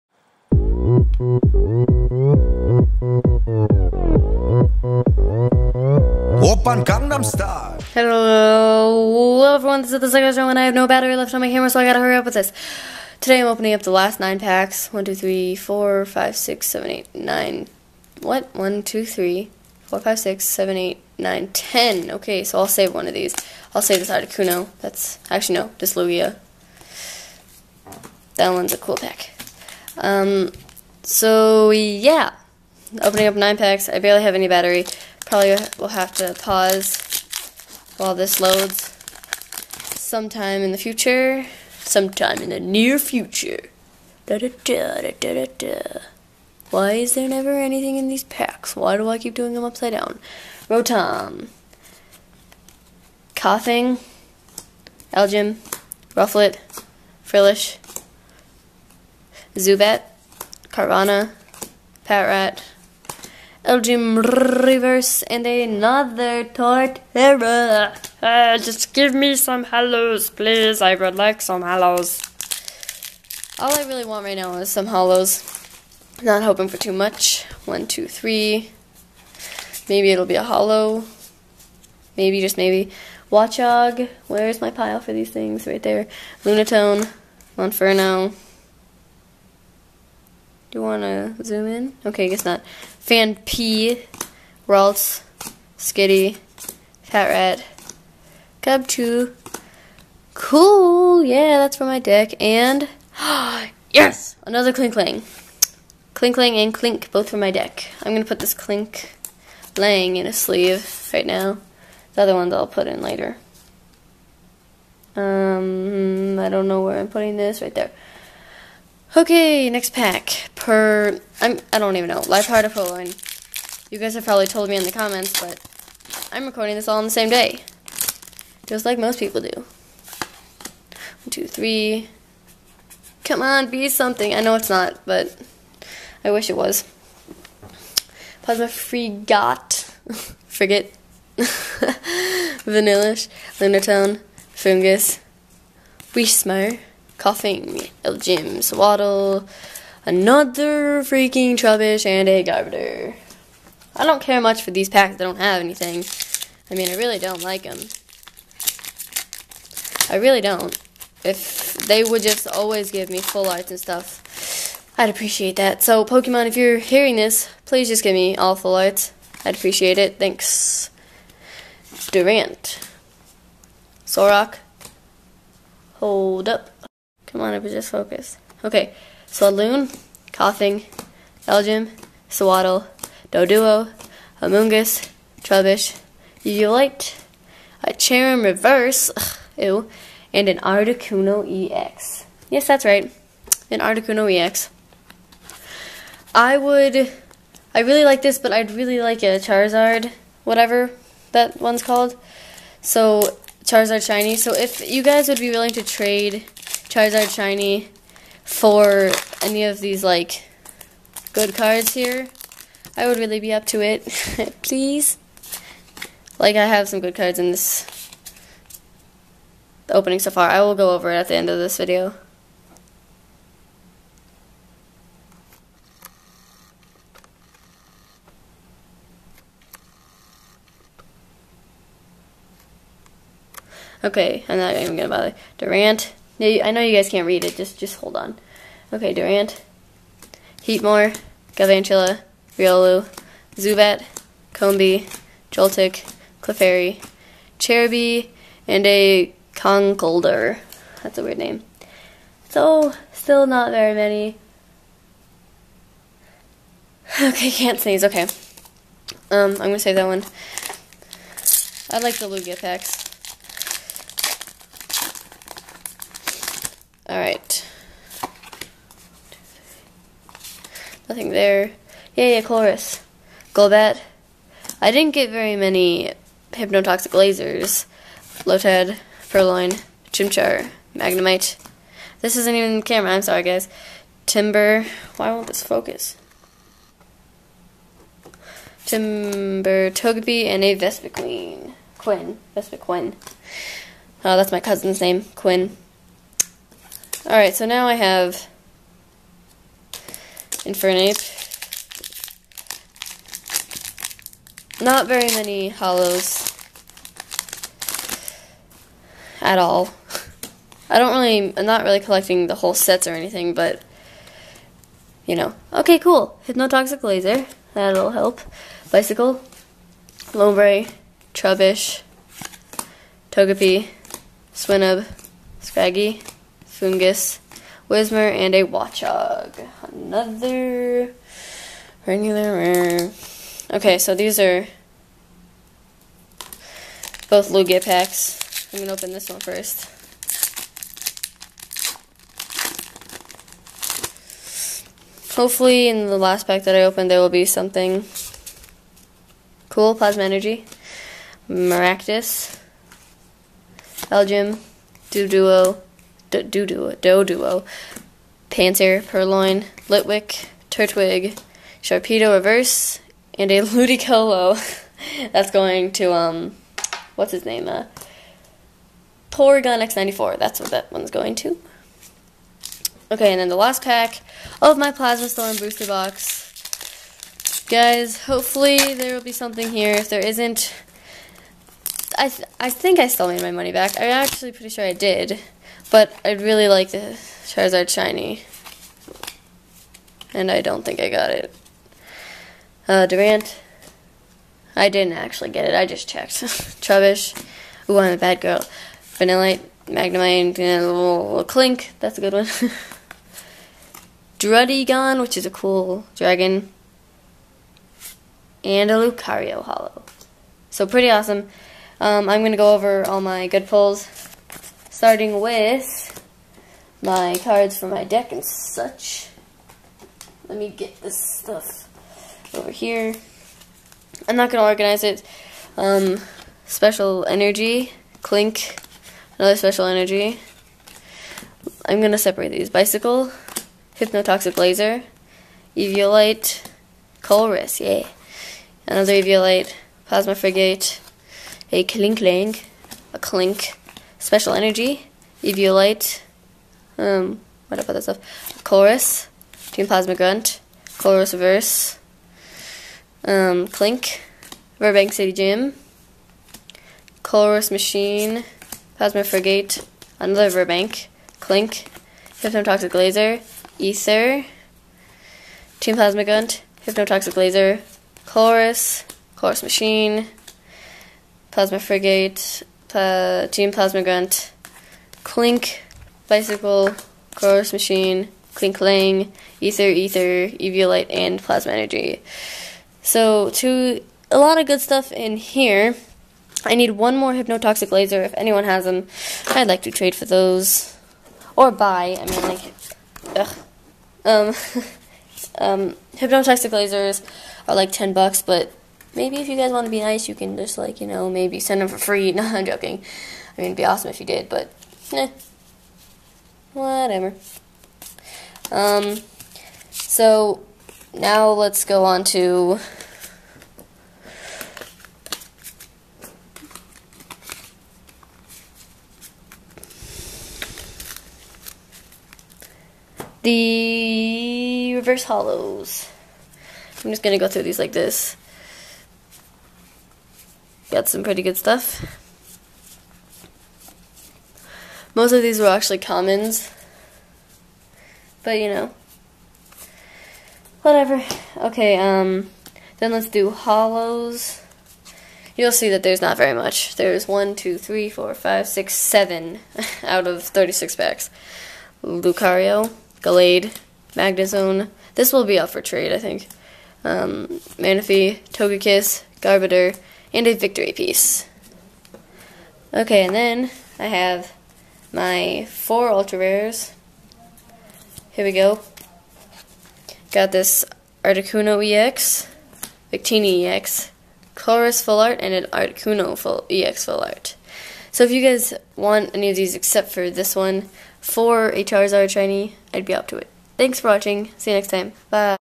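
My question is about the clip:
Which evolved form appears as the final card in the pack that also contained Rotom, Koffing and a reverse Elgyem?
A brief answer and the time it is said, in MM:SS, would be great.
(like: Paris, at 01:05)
Torterra, at 01:06.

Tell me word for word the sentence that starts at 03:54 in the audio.
Okay, I'm not even gonna bother.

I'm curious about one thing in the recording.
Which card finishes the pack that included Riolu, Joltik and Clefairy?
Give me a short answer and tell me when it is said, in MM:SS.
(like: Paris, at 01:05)
Conkeldurr, at 04:09.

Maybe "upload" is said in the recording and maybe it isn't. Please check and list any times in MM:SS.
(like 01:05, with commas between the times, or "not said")
not said.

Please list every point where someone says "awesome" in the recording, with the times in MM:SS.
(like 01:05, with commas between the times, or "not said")
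06:51, 08:23.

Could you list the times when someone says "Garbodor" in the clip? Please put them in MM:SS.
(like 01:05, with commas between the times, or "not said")
02:32, 09:19.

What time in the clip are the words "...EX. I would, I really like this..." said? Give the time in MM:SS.
03:14.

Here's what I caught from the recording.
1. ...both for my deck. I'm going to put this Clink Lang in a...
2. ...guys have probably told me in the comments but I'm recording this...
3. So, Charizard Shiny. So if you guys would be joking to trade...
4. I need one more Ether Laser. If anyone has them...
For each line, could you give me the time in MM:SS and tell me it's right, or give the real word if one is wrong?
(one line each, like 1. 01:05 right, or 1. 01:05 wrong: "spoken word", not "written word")
1. 01:47 right
2. 02:03 right
3. 03:22 wrong: "willing", not "joking"
4. 08:06 wrong: "Hypnotoxic", not "Ether".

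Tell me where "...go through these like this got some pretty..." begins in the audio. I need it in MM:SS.
08:47.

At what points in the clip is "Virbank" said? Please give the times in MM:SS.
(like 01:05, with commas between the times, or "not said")
07:34, 07:40.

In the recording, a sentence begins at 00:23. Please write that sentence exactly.
I'll save this out of That's actually no, this Lugia.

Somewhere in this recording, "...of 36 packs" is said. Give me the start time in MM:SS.
09:10.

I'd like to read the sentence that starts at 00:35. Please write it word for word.
Probably will have to pause while this loads sometime in the future.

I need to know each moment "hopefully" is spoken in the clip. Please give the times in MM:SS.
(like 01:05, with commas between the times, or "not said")
05:45, 06:18.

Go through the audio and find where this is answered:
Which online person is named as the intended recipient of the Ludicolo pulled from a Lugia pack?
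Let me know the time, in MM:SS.
06:09.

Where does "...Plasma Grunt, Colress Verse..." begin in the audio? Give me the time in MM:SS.
07:29.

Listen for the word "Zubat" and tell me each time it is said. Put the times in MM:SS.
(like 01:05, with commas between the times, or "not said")
00:59, 04:03.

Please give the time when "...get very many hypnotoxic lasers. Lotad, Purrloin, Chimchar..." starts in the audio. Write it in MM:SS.
04:35.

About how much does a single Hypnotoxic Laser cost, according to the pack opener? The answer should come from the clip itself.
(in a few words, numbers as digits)
$10.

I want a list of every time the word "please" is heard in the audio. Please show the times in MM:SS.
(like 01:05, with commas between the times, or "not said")
01:10, 02:47, 03:34.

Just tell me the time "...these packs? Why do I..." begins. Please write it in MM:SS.
00:48.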